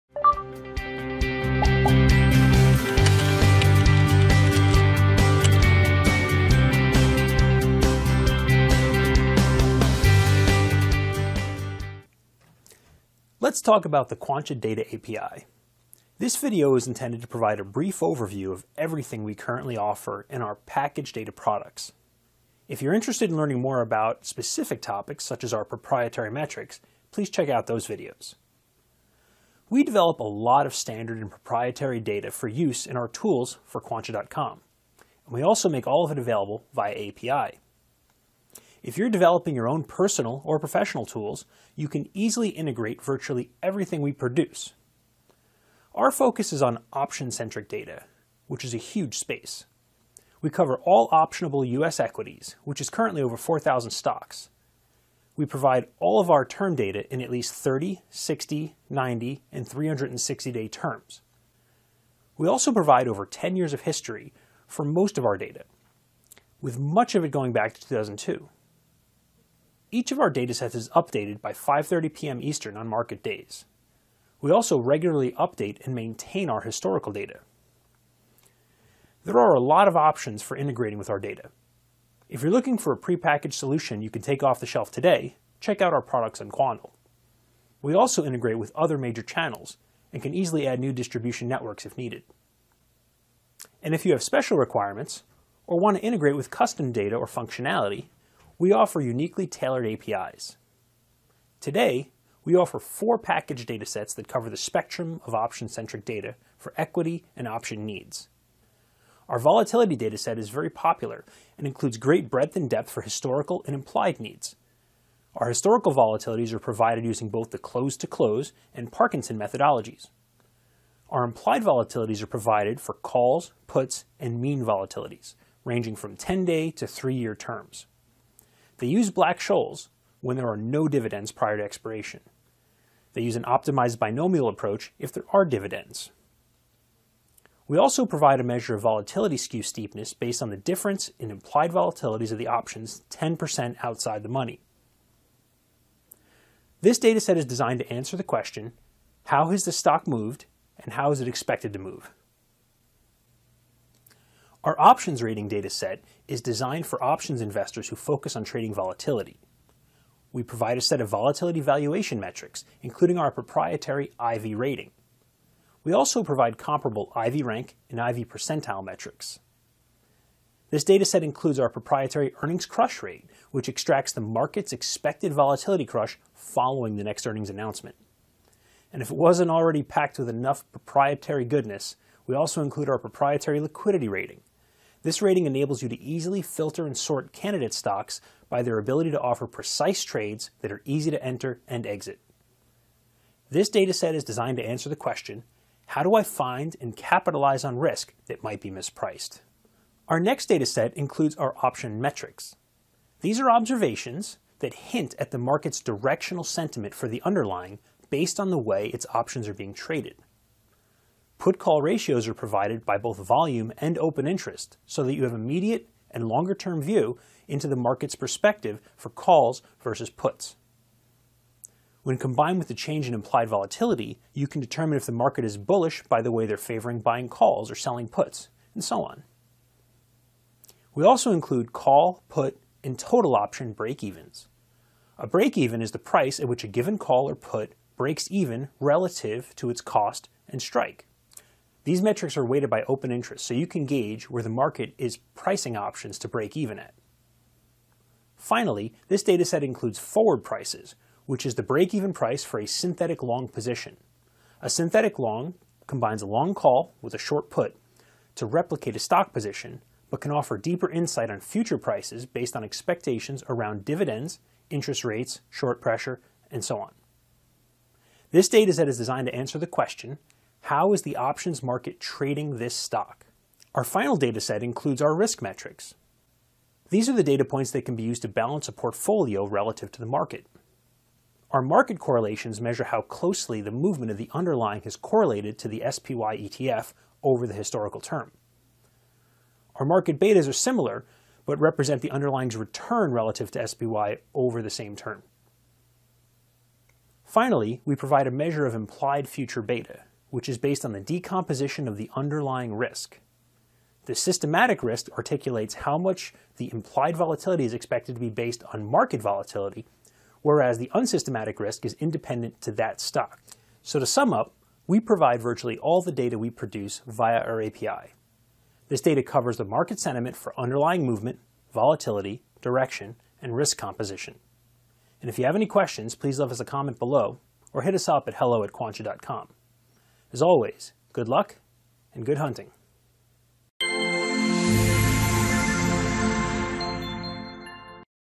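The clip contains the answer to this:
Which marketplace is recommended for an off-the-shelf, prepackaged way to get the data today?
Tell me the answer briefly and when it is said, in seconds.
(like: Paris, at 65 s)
Quandl, at 86 s.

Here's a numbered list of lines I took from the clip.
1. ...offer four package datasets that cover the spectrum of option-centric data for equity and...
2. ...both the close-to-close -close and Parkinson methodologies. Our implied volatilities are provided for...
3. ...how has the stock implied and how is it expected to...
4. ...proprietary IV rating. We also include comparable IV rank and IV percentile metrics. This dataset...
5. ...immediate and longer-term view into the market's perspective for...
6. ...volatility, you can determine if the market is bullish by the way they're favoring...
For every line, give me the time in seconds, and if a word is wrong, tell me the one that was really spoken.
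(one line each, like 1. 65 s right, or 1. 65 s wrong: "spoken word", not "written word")
1. 102 s right
2. 117 s right
3. 149 s wrong: "moved", not "implied"
4. 163 s wrong: "provide", not "include"
5. 215 s right
6. 223 s right.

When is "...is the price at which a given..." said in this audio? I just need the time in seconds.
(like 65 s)
235 s.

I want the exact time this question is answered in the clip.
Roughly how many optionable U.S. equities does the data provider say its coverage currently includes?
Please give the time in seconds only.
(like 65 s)
53 s.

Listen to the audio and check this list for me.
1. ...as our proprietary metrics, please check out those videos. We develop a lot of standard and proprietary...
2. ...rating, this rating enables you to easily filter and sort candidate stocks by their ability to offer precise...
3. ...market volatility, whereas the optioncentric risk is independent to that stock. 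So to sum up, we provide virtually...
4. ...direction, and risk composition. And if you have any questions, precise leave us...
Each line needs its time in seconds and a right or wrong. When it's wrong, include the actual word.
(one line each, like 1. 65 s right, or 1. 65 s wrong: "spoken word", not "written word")
1. 25 s right
2. 184 s right
3. 308 s wrong: "unsystematic", not "optioncentric"
4. 322 s wrong: "please", not "precise".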